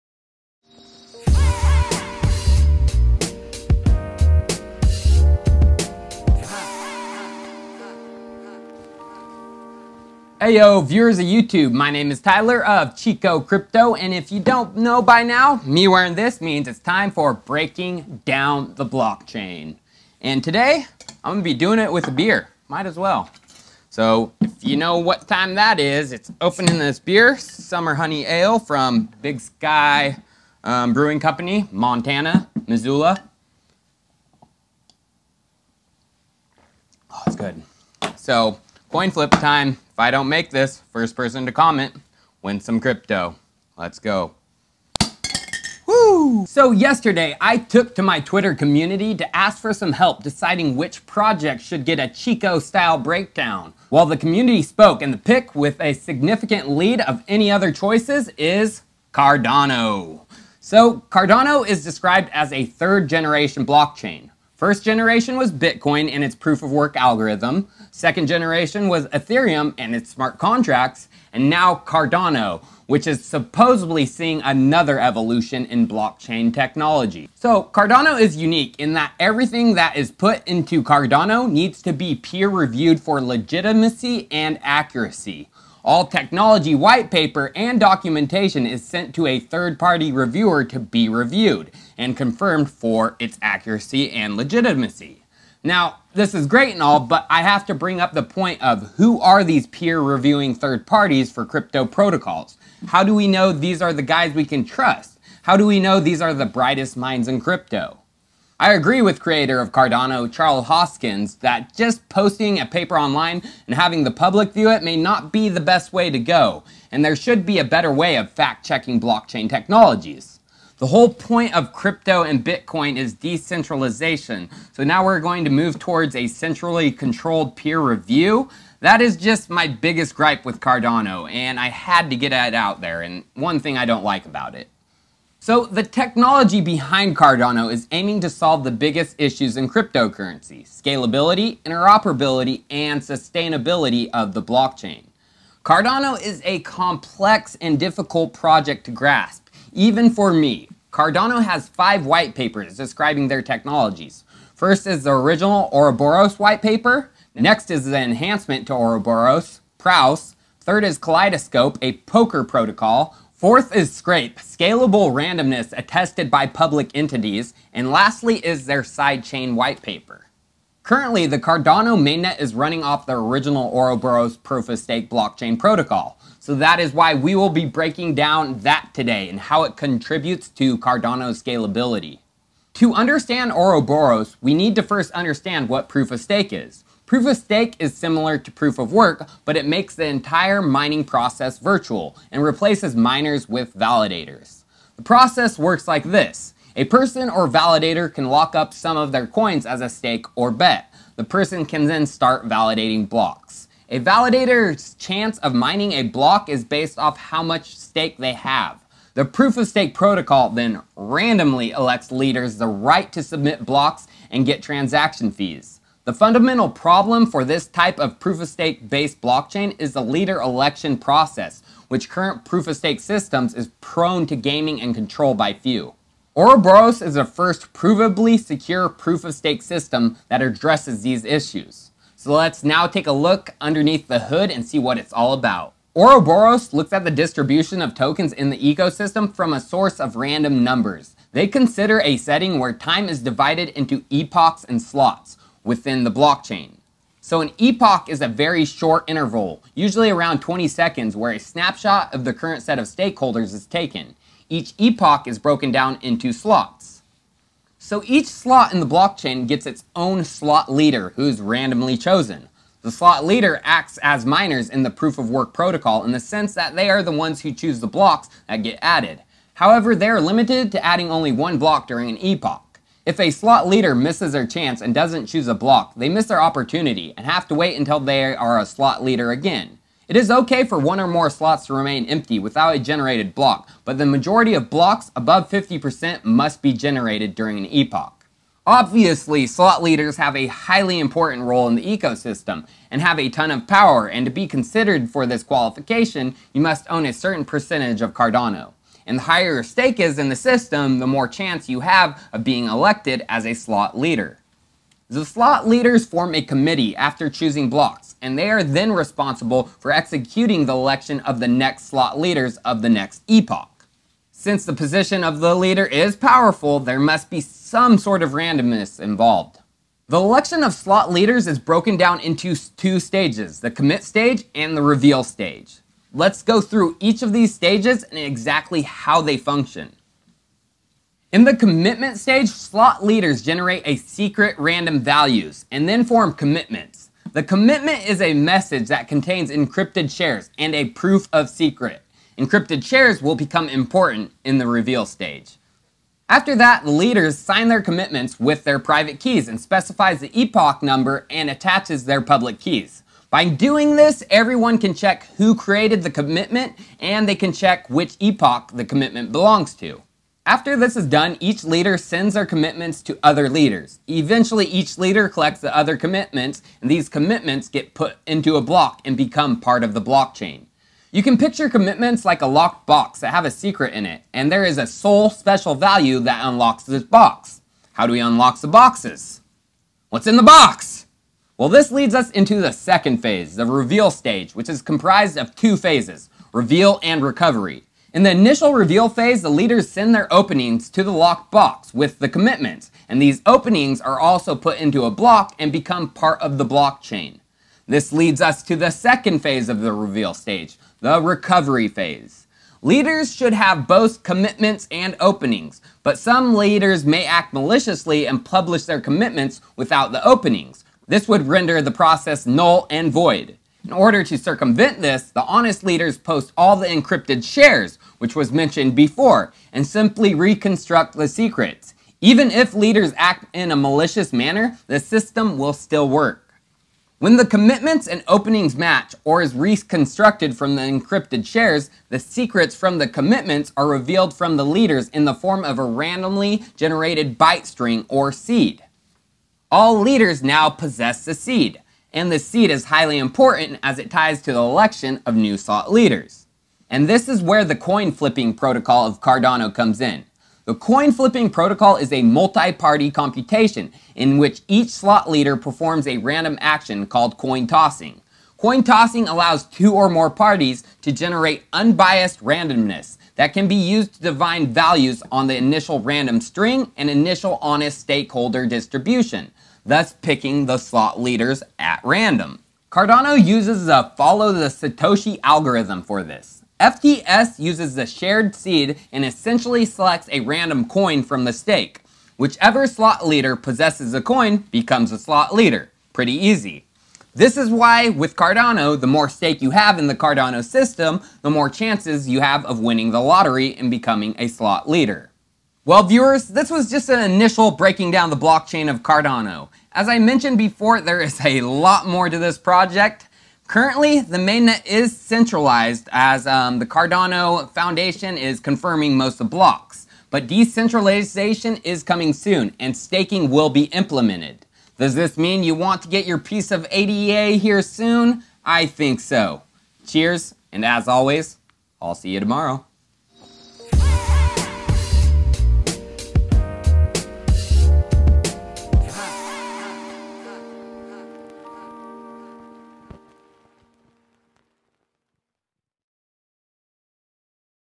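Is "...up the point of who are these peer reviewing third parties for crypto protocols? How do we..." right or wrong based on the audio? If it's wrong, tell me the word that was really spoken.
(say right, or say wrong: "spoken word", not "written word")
right.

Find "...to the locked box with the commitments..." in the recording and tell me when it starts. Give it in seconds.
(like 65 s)
390 s.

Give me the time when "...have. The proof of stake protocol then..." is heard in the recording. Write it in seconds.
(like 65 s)
208 s.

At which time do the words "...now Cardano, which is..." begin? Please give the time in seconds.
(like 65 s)
71 s.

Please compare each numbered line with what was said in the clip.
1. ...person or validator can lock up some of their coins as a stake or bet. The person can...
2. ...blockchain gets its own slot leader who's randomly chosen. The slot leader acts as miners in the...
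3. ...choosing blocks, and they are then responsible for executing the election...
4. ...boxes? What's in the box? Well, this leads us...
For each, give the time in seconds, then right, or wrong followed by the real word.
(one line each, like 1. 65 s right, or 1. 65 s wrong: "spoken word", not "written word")
1. 196 s right
2. 258 s right
3. 307 s right
4. 378 s right.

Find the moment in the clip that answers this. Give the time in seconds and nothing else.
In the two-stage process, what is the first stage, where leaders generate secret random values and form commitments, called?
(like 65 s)
323 s.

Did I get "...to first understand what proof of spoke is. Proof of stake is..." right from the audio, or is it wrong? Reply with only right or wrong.
wrong.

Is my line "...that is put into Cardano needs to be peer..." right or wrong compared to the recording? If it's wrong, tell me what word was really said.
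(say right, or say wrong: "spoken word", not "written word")
right.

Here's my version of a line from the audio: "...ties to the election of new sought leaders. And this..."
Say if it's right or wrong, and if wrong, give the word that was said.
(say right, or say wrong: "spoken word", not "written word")
right.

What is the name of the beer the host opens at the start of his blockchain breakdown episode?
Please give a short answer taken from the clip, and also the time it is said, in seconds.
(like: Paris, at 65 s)
Summer Honey Ale, at 27 s.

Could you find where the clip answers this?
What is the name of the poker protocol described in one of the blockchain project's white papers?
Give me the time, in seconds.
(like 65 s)
160 s.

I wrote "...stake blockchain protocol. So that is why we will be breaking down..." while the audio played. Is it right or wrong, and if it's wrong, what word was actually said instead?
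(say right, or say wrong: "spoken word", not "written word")
right.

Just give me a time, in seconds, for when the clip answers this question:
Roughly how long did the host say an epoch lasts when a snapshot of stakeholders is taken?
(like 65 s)
250 s.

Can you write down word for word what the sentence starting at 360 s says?
After this is done, each leader sends their commitments to other leaders.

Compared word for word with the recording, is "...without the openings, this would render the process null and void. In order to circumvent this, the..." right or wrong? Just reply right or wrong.
right.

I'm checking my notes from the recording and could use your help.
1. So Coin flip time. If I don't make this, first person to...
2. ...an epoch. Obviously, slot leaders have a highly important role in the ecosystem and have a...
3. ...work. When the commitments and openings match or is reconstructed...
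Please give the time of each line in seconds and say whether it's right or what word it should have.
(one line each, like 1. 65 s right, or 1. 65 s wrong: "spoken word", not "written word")
1. 38 s right
2. 287 s right
3. 426 s right.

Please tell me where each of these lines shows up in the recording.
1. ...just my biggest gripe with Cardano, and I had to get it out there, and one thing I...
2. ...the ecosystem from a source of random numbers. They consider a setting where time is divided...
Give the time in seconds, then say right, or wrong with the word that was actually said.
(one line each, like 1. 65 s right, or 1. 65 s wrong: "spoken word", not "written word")
1. 129 s right
2. 238 s right.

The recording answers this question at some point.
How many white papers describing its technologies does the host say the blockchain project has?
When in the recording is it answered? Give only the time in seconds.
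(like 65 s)
151 s.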